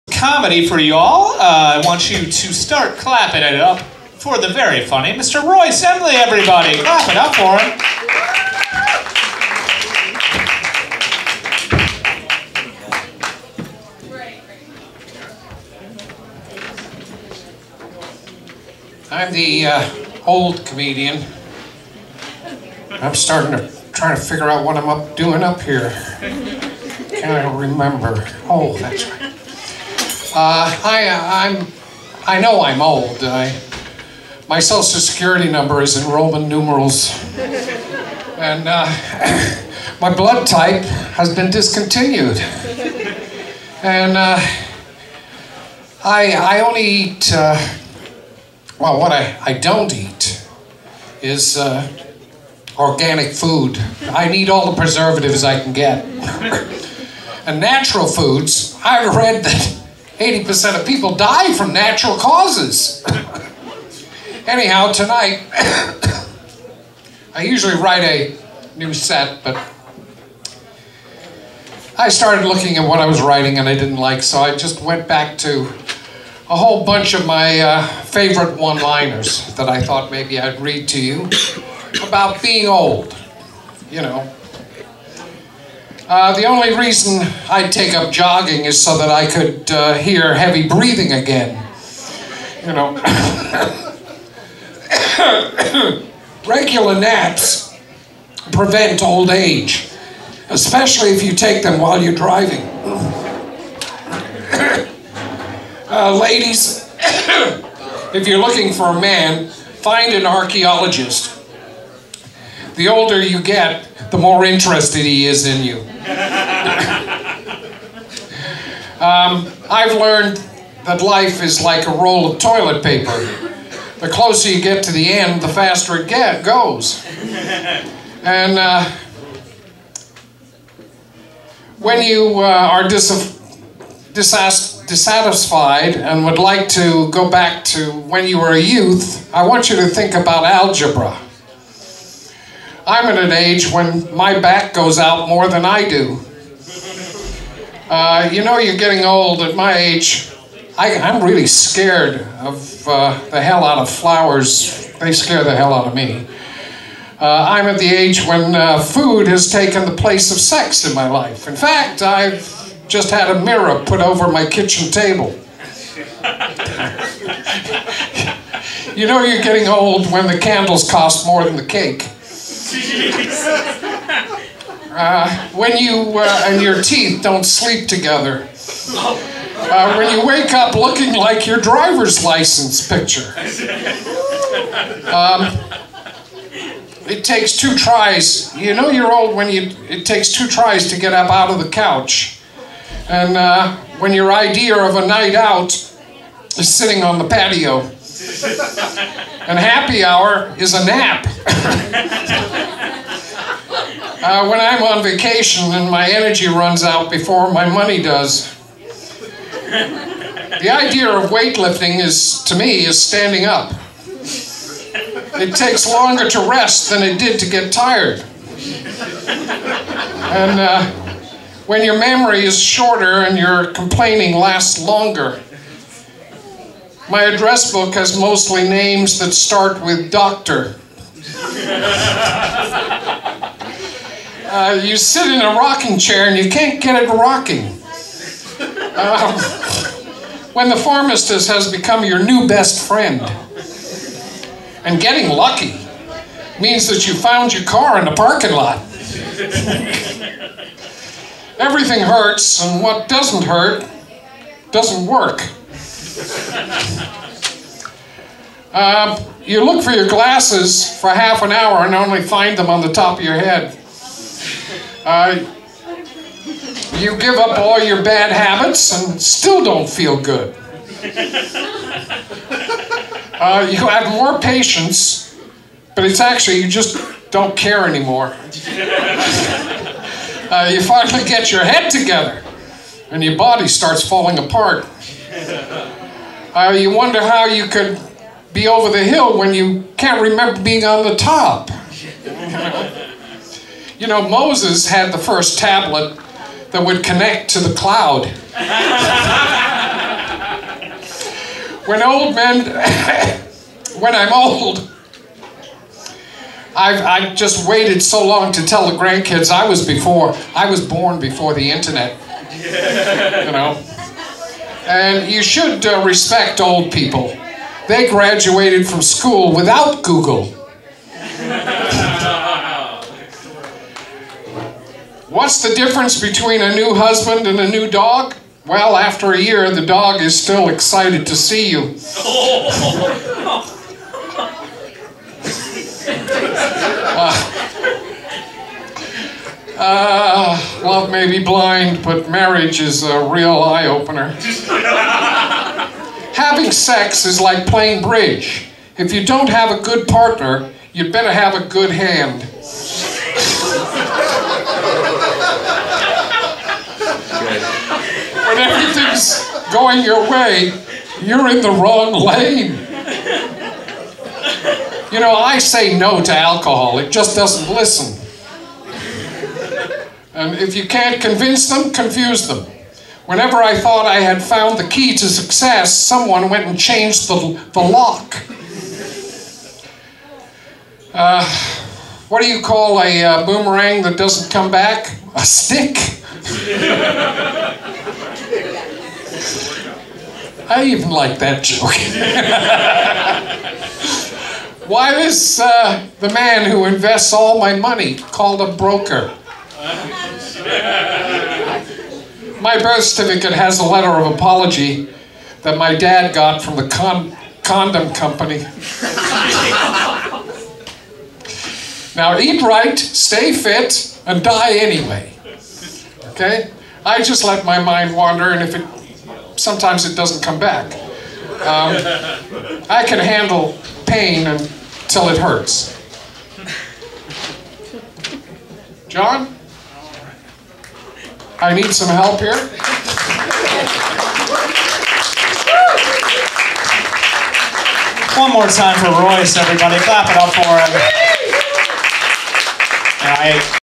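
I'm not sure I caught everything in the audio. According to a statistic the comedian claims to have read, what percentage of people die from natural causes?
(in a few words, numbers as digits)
80%.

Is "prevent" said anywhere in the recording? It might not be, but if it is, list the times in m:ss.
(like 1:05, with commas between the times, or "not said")
1:38.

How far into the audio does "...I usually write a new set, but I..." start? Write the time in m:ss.
1:07.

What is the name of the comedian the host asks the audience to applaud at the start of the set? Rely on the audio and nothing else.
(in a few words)
Royce Emley.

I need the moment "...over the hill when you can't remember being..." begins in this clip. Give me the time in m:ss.
4:48.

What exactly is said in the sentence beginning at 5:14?
And you should uh, respect old people they graduated from school without Google.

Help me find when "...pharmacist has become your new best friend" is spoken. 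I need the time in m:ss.
4:00.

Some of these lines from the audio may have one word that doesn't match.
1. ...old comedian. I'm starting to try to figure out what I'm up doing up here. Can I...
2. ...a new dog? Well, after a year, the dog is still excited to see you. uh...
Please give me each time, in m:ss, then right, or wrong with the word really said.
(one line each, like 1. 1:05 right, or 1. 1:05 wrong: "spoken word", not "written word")
1. 0:20 right
2. 5:27 right.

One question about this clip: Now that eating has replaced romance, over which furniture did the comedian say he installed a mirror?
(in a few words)
Kitchen table.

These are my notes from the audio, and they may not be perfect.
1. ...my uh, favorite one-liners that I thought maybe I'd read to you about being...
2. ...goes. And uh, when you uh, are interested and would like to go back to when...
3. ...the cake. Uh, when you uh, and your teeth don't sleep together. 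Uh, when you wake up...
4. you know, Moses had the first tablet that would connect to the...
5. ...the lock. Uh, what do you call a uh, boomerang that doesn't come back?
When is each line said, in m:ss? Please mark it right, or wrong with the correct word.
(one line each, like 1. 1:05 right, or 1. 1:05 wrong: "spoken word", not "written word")
1. 1:17 right
2. 2:06 wrong: "dissatisfied", not "interested"
3. 2:51 right
4. 4:53 right
5. 6:17 right.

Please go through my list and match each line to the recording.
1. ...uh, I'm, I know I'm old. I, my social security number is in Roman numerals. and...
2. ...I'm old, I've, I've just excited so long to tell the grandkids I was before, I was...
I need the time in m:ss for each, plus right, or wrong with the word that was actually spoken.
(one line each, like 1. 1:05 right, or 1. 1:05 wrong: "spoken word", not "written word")
1. 0:31 right
2. 5:04 wrong: "waited", not "excited".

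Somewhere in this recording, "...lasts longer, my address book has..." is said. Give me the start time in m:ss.
3:44.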